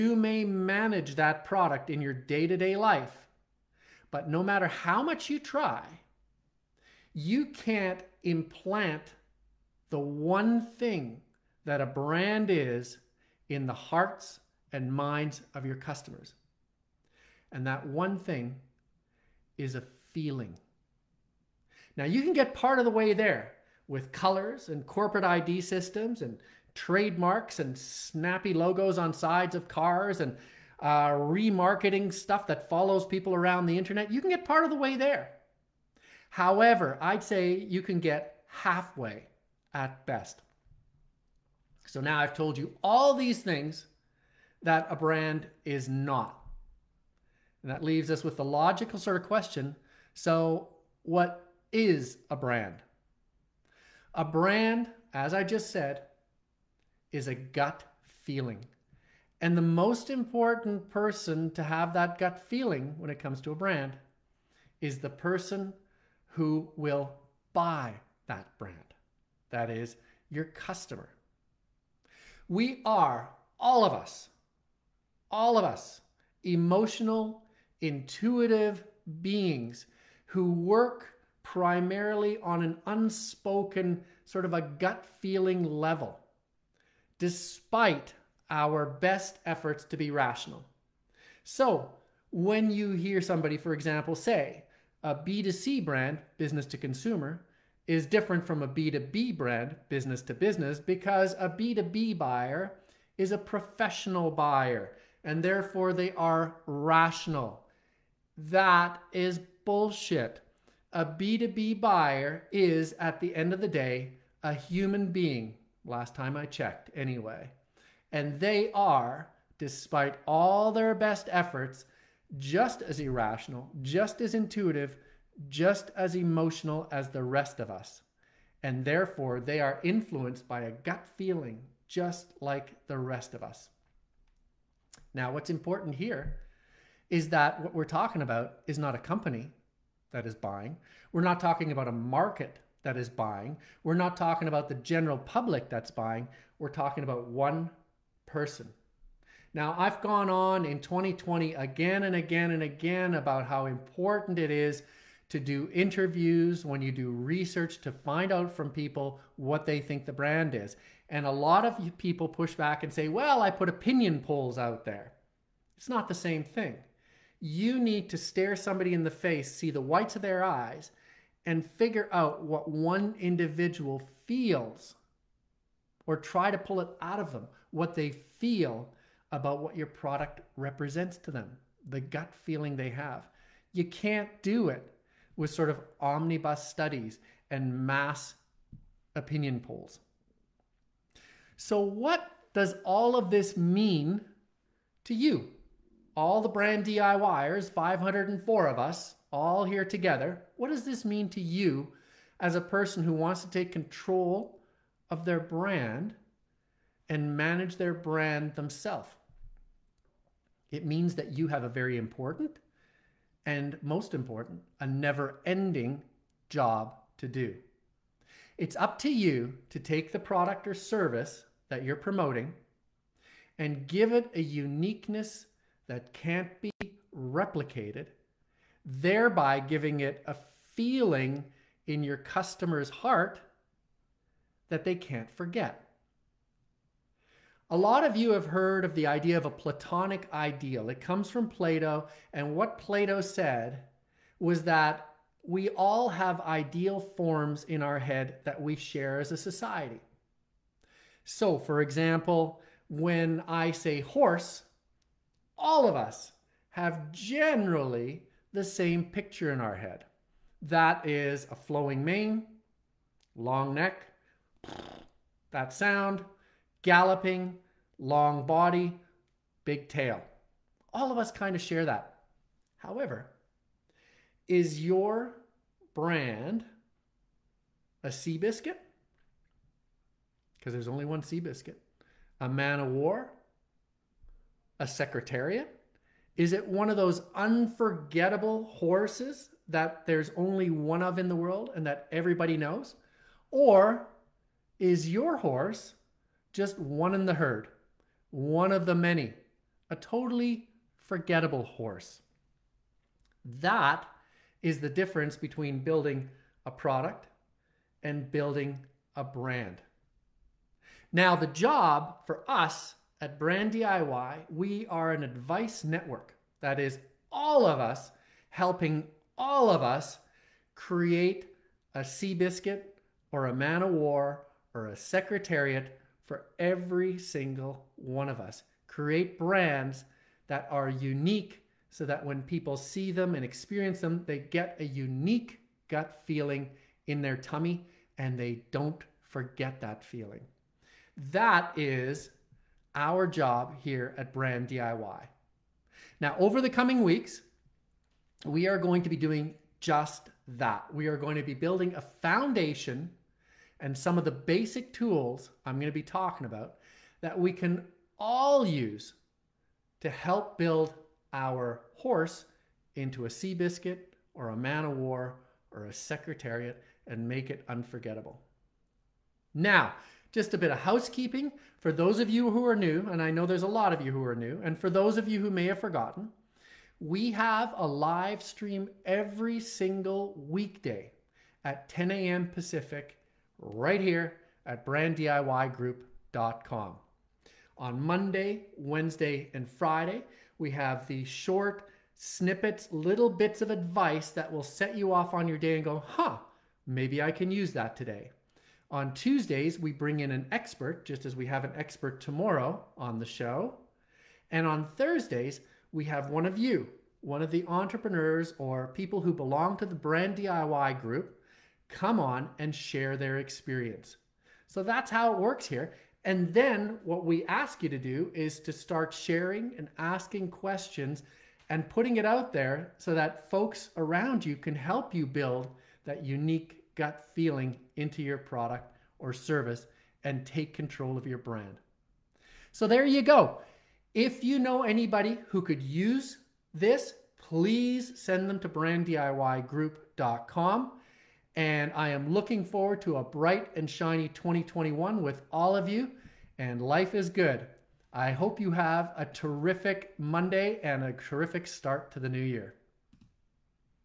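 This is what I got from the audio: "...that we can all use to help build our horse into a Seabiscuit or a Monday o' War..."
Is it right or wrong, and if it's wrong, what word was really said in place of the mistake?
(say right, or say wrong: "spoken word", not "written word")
wrong: "Man", not "Monday".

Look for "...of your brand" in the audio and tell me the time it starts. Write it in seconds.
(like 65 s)
431 s.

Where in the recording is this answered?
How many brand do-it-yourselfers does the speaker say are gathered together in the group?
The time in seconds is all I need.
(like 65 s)
197 s.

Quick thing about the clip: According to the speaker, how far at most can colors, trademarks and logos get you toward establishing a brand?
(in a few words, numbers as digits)
Halfway.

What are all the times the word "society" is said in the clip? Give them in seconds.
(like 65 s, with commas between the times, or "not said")
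249 s.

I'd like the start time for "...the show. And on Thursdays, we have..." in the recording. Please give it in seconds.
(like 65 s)
403 s.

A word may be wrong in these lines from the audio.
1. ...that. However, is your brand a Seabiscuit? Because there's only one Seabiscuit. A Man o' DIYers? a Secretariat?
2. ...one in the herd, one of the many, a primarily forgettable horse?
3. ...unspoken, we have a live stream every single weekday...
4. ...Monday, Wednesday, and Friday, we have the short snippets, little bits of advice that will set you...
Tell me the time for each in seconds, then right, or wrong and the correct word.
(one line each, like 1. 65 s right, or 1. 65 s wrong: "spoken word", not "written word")
1. 271 s wrong: "War", not "DIYers"
2. 296 s wrong: "totally", not "primarily"
3. 375 s wrong: "forgotten", not "unspoken"
4. 388 s right.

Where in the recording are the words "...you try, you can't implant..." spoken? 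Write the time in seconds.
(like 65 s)
5 s.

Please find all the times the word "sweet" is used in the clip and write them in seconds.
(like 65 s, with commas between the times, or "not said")
not said.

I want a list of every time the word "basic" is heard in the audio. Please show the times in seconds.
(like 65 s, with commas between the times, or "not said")
354 s.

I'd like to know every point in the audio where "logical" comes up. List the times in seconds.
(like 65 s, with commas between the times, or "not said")
48 s.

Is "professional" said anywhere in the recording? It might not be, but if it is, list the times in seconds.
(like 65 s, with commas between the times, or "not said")
103 s.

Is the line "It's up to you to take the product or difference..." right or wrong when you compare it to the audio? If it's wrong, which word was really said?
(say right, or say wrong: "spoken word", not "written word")
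wrong: "service", not "difference".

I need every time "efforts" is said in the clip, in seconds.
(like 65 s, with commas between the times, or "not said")
89 s, 121 s.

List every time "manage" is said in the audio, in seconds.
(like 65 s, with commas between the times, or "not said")
0 s, 207 s.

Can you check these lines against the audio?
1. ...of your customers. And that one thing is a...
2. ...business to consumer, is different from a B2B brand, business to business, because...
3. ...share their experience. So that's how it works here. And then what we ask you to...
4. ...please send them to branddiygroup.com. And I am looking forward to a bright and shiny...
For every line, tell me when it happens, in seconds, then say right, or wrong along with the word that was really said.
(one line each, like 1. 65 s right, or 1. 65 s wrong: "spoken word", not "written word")
1. 15 s right
2. 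96 s right
3. 412 s right
4. 437 s right.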